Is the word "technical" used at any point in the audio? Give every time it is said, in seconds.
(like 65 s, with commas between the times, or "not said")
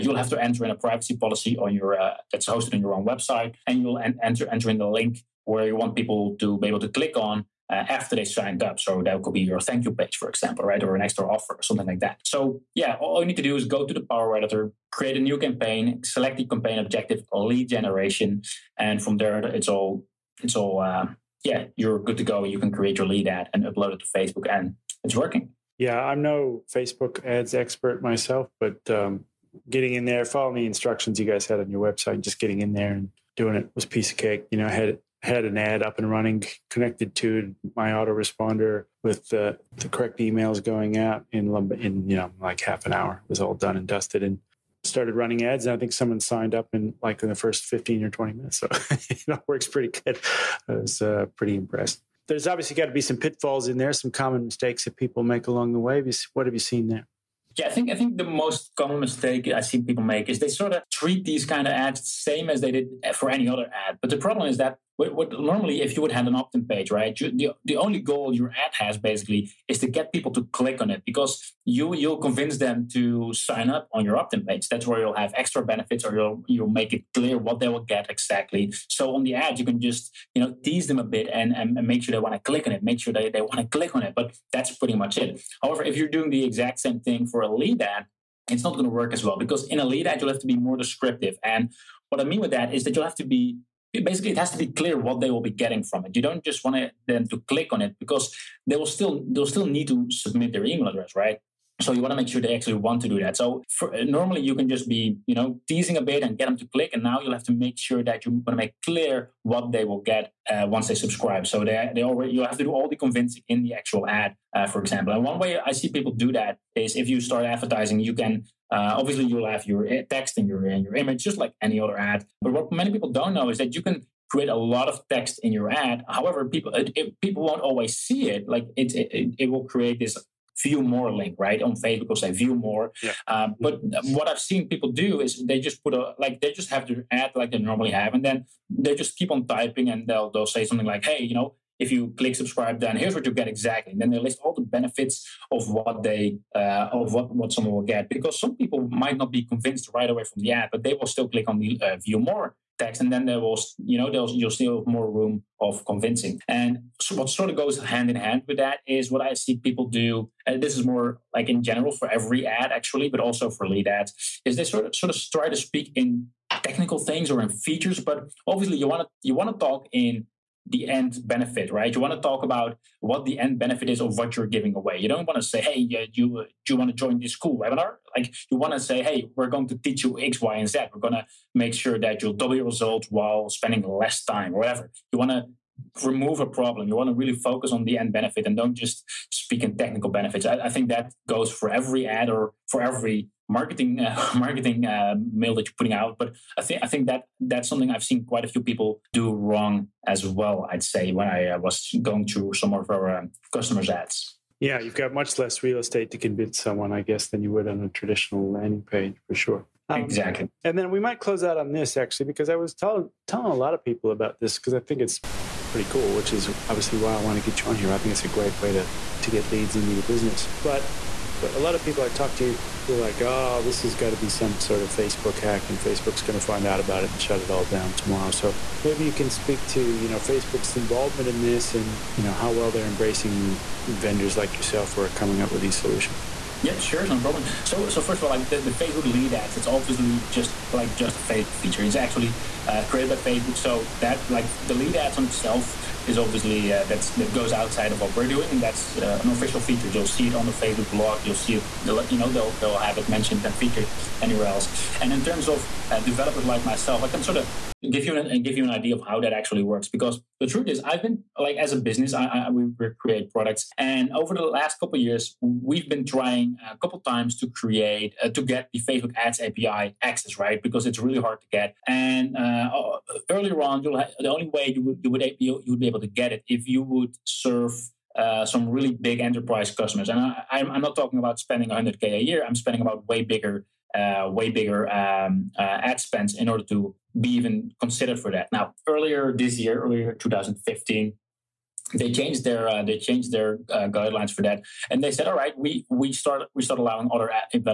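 166 s, 189 s.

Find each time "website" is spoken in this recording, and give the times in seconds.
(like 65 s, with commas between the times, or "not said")
3 s, 31 s.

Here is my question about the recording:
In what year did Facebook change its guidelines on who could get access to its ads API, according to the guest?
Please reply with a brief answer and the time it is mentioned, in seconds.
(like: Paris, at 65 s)
2015, at 290 s.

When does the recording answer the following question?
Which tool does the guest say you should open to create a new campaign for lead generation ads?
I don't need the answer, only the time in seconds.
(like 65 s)
14 s.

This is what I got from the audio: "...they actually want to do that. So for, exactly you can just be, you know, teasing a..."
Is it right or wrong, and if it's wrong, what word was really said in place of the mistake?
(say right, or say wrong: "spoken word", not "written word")
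wrong: "normally", not "exactly".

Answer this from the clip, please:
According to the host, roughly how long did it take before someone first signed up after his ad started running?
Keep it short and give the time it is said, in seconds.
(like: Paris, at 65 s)
15 or 20 minutes, at 47 s.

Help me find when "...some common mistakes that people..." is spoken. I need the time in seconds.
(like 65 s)
53 s.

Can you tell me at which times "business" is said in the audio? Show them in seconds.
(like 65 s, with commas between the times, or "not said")
220 s, 261 s.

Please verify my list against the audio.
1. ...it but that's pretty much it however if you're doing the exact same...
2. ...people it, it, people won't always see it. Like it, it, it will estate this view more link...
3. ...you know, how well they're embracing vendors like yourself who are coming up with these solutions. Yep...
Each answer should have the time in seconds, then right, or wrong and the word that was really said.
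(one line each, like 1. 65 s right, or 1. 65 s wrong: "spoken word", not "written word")
1. 84 s right
2. 126 s wrong: "create", not "estate"
3. 232 s right.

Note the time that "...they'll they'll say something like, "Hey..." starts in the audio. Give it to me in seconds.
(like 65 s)
140 s.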